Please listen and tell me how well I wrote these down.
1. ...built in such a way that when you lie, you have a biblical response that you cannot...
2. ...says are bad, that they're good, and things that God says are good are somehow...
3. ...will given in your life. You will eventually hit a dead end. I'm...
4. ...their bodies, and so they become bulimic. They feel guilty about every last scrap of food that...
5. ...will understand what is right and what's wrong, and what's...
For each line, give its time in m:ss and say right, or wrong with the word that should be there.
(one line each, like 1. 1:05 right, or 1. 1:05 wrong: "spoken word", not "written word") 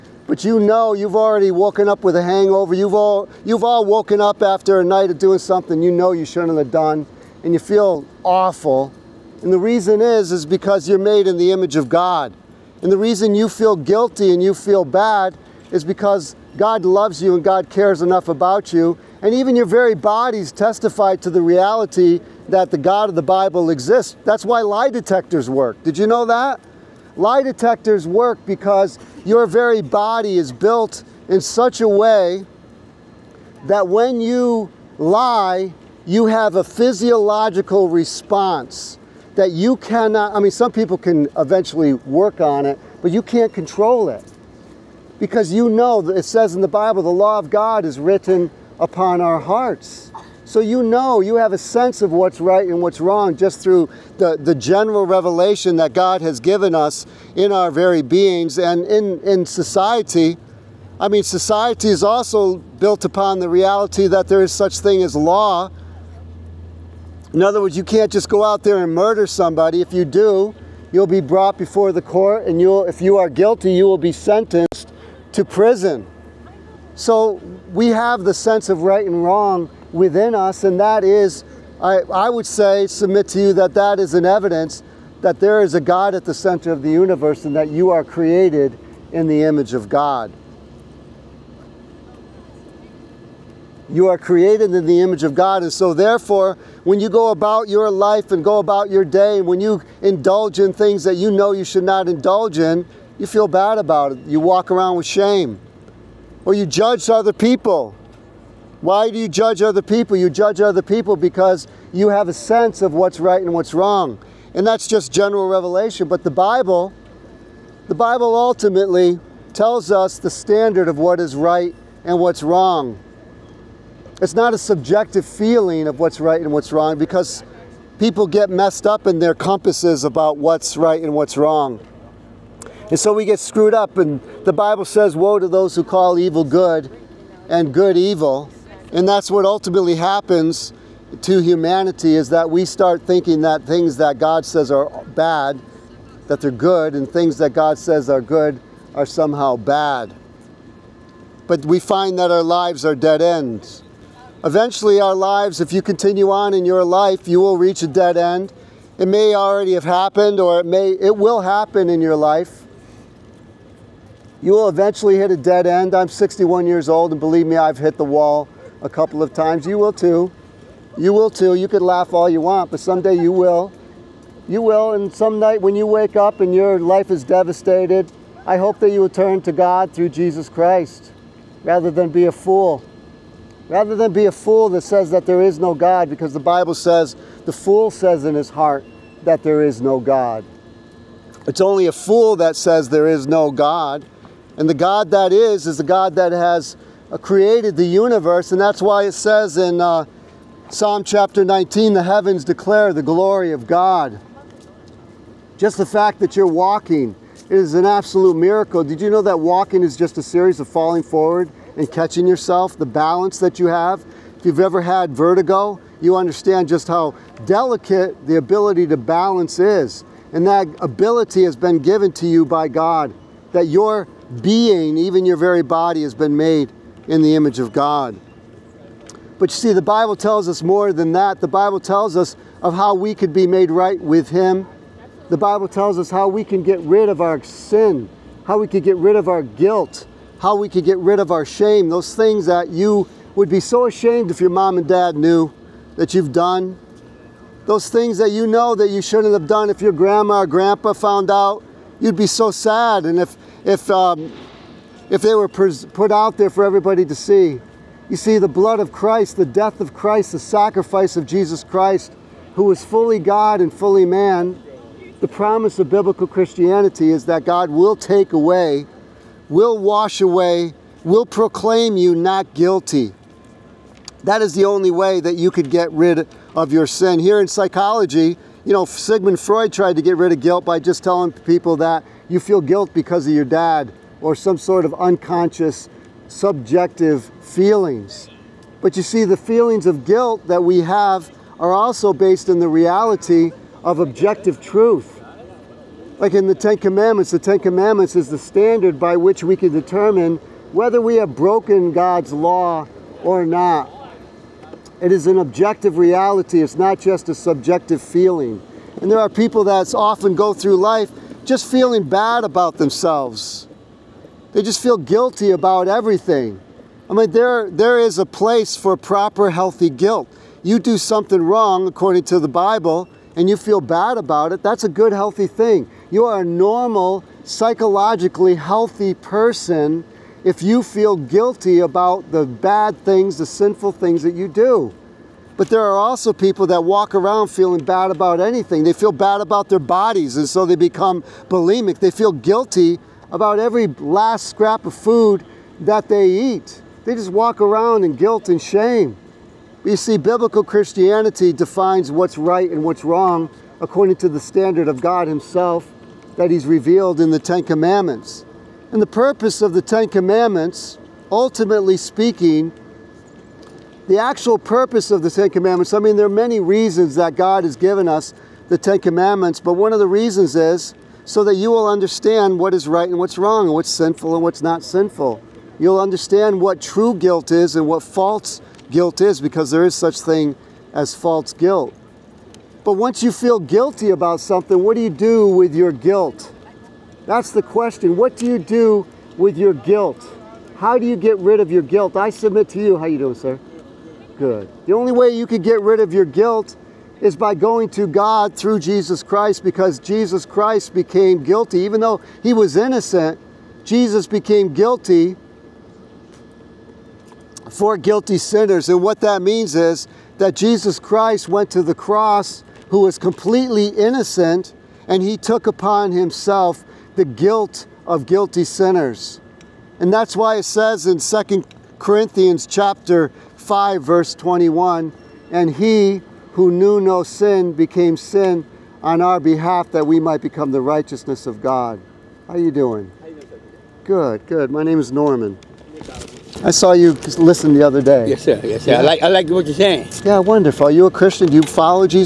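1. 0:30 wrong: "physiological", not "biblical"
2. 2:24 right
3. 2:41 wrong: "happen", not "given"
4. 5:39 right
5. 6:11 right.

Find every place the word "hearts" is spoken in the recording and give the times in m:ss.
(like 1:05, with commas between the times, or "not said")
0:49, 3:08.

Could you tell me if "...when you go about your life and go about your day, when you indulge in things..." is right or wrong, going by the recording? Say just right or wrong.
right.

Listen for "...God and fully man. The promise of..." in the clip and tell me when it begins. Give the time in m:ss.
4:23.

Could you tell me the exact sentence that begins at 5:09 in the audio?
And there are people that often go through life just feeling bad about themselves they just feel guilty about everything.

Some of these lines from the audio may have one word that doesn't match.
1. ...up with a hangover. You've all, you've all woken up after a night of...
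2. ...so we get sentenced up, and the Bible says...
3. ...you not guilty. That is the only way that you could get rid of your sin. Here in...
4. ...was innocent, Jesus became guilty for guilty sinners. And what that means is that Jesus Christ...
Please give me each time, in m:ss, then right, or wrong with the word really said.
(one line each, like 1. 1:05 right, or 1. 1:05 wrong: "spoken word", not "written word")
1. 0:01 right
2. 2:12 wrong: "screwed", not "sentenced"
3. 4:31 right
4. 6:42 right.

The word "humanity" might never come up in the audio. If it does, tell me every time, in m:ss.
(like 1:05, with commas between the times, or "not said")
2:21.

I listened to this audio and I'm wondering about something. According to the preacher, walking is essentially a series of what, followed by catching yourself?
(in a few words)
Falling forward.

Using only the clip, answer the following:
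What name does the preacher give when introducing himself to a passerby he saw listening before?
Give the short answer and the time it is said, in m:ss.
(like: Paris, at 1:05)
Norman, at 7:15.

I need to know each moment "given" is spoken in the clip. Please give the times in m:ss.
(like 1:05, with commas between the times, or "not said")
0:56, 3:41, 6:07.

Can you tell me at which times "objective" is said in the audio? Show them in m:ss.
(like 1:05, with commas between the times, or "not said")
4:53, 5:05.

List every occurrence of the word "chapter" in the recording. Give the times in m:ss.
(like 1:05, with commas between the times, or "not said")
3:21, 7:02.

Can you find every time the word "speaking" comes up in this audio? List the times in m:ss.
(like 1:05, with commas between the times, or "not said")
6:01.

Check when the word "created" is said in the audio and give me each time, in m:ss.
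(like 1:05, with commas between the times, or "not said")
1:28, 1:34, 3:17.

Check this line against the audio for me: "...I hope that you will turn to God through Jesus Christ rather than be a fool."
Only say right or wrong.
right.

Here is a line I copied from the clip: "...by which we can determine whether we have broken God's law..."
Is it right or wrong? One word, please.
right.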